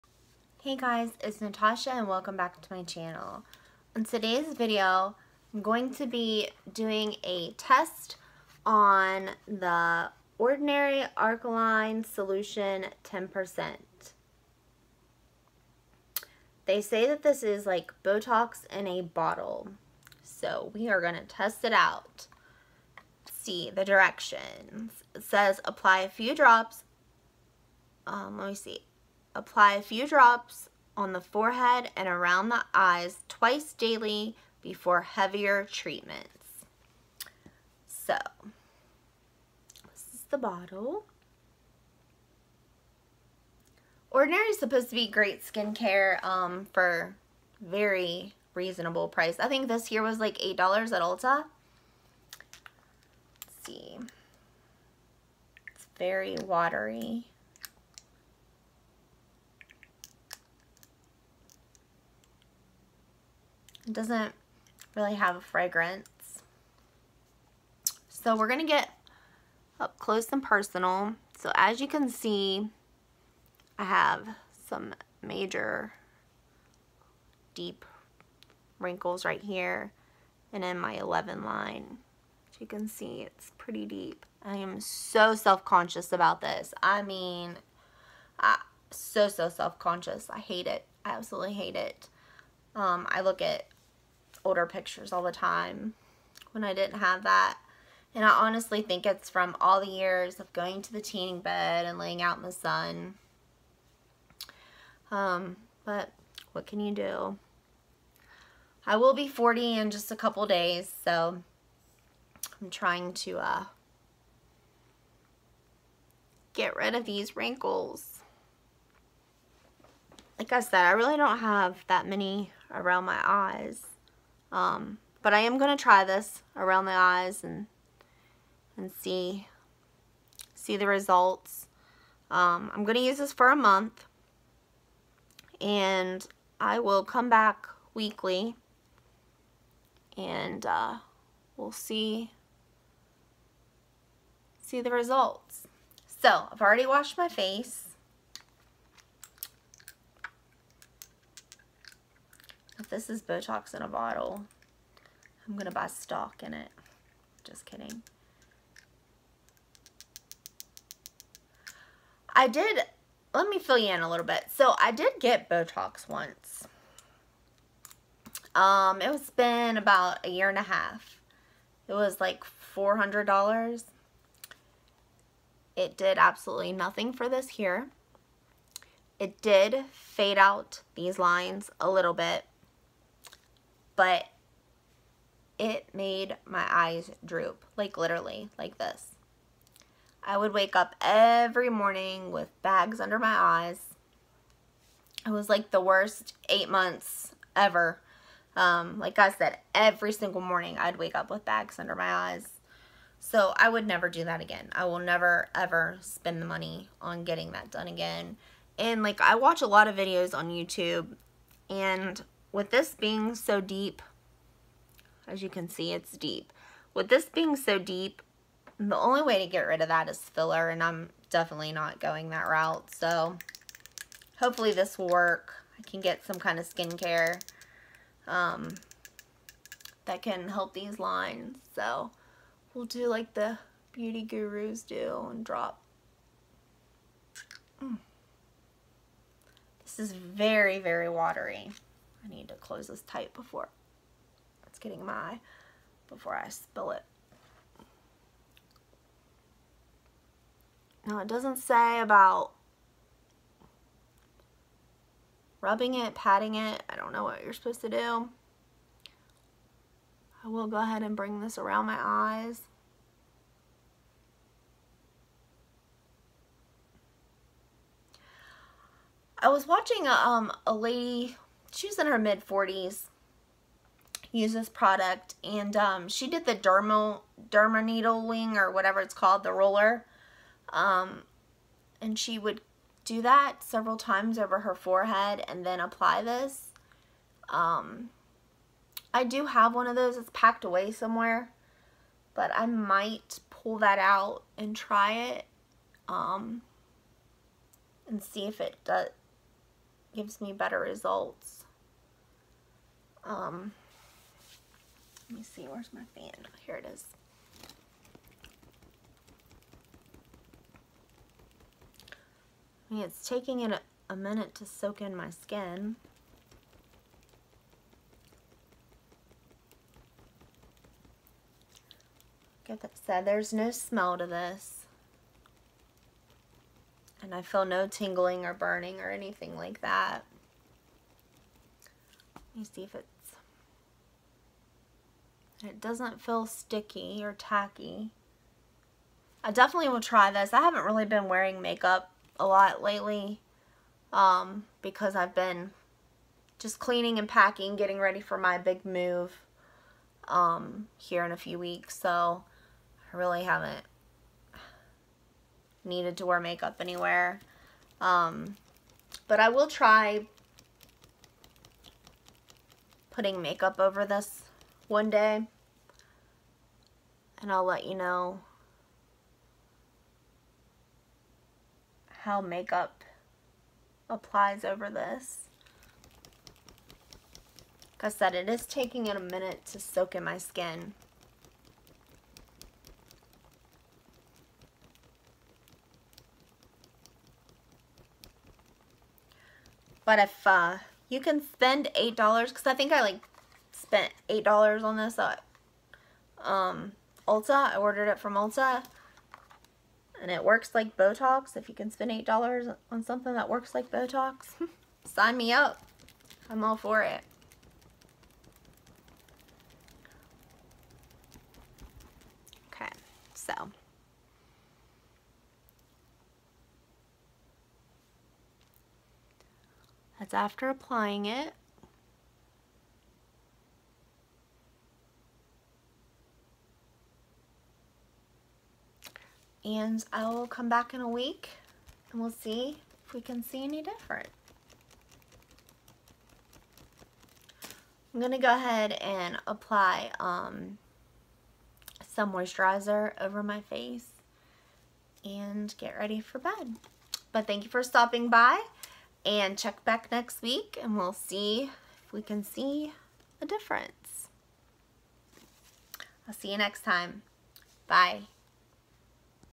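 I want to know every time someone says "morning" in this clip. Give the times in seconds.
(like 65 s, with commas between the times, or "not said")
191 s, 200 s.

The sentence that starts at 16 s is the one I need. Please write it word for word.
They say that this is like Botox in a bottle.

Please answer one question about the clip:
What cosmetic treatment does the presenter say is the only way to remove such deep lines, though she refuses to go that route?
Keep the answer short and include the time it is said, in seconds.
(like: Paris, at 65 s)
filler, at 220 s.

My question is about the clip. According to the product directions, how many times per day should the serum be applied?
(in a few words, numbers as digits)
twice daily.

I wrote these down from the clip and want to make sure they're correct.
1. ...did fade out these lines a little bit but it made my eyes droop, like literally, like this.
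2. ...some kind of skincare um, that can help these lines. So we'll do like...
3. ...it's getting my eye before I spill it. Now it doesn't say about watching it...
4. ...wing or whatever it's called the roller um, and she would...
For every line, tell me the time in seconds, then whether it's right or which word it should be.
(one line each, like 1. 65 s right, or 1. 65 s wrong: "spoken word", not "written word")
1. 179 s right
2. 226 s right
3. 244 s wrong: "rubbing", not "watching"
4. 278 s right.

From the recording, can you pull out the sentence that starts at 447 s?
But thank you for stopping by and check back next week and we'll see if we can see a difference.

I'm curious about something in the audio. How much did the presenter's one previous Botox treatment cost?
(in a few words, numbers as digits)
$400.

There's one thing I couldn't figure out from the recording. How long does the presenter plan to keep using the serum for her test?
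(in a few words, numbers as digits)
a month.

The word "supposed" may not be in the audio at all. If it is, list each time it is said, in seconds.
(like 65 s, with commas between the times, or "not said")
44 s, 257 s.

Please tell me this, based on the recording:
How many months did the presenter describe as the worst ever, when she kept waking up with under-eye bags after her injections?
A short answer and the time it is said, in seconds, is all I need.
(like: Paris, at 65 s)
8, at 196 s.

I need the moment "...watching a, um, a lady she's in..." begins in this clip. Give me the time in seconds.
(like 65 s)
269 s.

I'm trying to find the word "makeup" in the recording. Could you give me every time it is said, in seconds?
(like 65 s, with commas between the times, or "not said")
341 s, 356 s, 363 s, 372 s.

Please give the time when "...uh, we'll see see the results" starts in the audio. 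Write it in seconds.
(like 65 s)
140 s.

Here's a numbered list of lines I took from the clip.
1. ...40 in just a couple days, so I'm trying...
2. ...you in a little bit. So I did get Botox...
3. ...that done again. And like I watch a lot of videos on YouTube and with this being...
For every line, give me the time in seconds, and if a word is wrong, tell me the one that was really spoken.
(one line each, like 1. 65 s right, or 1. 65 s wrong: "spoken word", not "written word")
1. 109 s right
2. 163 s right
3. 207 s right.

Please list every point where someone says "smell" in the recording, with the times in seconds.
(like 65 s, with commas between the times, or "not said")
323 s.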